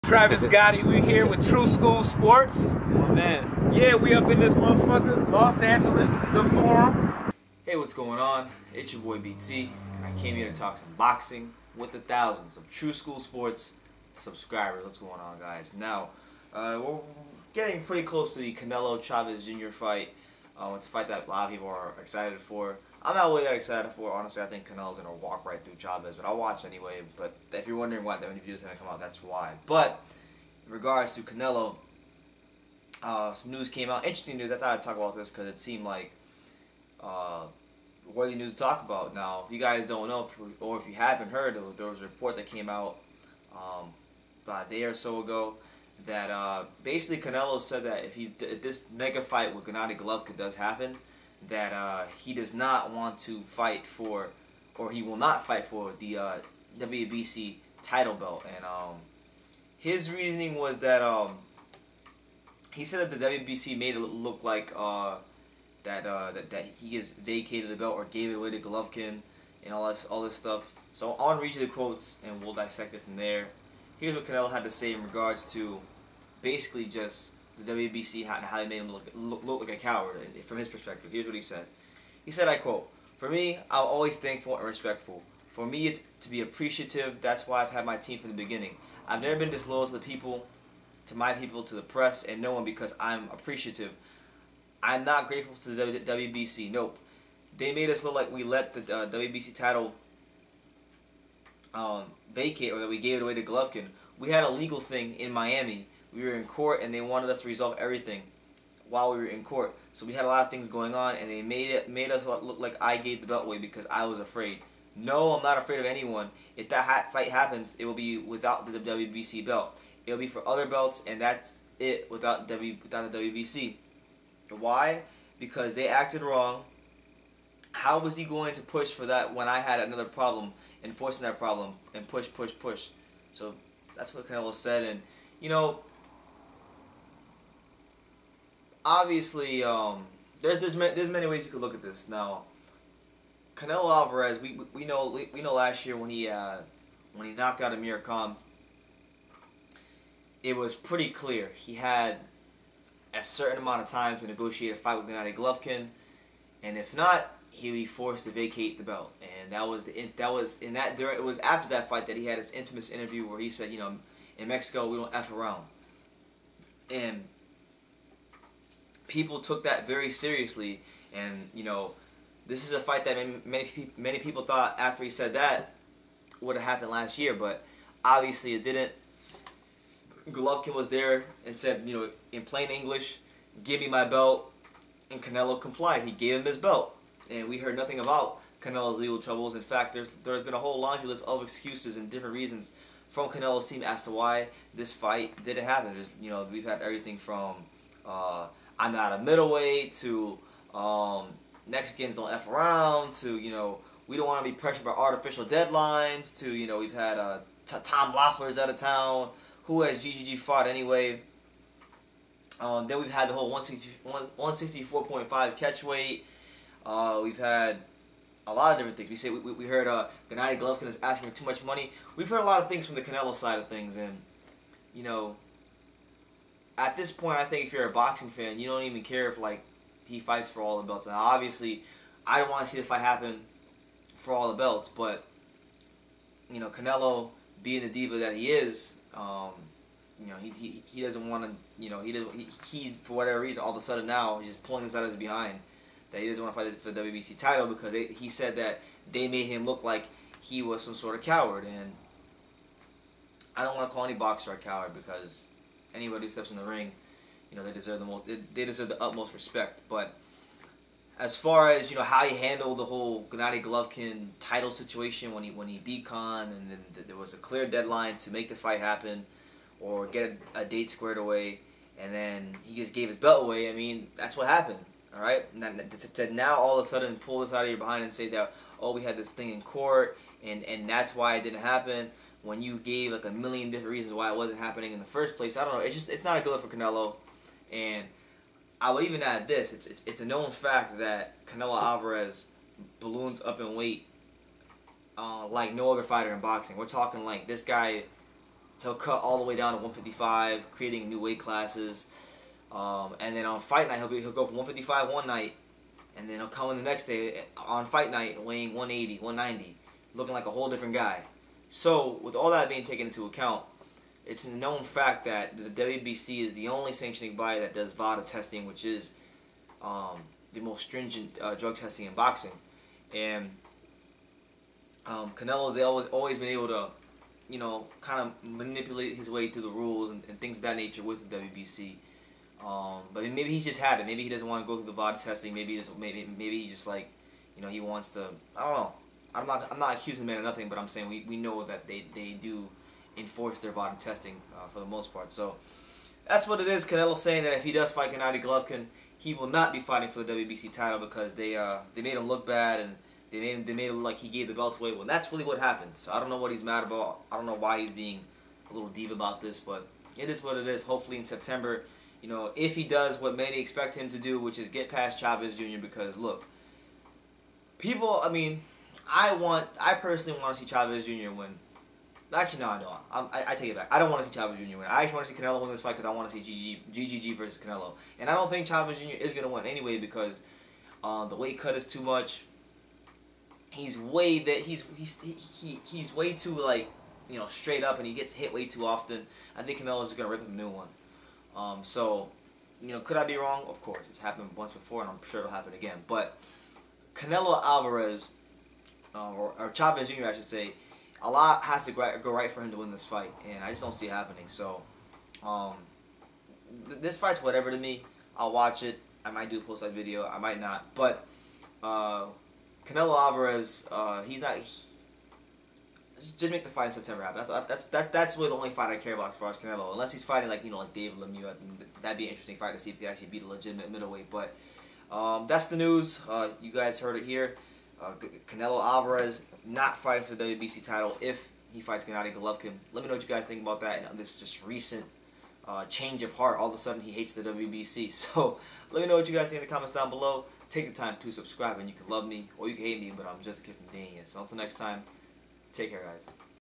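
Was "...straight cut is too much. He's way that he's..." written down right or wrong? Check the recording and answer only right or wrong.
wrong.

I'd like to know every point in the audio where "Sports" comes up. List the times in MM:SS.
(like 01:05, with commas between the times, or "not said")
00:02, 00:13.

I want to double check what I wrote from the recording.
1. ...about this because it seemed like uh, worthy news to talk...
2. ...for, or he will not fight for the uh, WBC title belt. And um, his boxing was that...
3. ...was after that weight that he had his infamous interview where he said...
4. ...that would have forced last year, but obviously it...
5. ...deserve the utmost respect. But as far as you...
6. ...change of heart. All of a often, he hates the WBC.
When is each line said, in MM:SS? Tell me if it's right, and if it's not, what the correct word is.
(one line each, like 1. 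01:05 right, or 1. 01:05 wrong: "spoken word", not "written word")
1. 00:34 right
2. 00:53 wrong: "reasoning", not "boxing"
3. 02:41 wrong: "fight", not "weight"
4. 02:55 wrong: "happened", not "forced"
5. 04:18 right
6. 07:15 wrong: "sudden", not "often".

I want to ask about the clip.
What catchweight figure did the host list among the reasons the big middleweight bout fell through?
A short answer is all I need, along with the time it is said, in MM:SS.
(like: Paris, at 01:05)
164.5, at 03:34.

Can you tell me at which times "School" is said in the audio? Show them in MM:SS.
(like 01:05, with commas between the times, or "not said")
00:01, 00:12.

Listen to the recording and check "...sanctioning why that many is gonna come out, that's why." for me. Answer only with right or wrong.
wrong.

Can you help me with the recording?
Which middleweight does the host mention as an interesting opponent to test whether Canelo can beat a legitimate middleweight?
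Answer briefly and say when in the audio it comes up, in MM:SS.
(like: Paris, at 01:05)
Dave Lemieux, at 07:00.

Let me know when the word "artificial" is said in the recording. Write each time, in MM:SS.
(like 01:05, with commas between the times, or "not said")
03:24.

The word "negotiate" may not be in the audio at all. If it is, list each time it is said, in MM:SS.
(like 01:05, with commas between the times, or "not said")
02:34.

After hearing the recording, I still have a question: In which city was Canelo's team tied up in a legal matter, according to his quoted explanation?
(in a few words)
Miami.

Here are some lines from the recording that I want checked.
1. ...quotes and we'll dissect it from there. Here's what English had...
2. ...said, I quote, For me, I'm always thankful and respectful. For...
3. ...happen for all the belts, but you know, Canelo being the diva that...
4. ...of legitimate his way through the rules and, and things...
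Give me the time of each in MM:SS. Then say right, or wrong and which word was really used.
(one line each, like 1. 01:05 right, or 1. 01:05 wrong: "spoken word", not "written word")
1. 01:11 wrong: "Canelo", not "English"
2. 01:22 right
3. 03:53 right
4. 05:28 wrong: "manipulate", not "legitimate".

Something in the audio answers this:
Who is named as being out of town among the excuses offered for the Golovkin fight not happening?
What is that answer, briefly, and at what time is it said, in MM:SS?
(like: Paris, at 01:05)
Tom Loeffler, at 03:27.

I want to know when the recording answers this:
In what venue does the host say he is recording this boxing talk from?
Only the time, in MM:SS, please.
00:06.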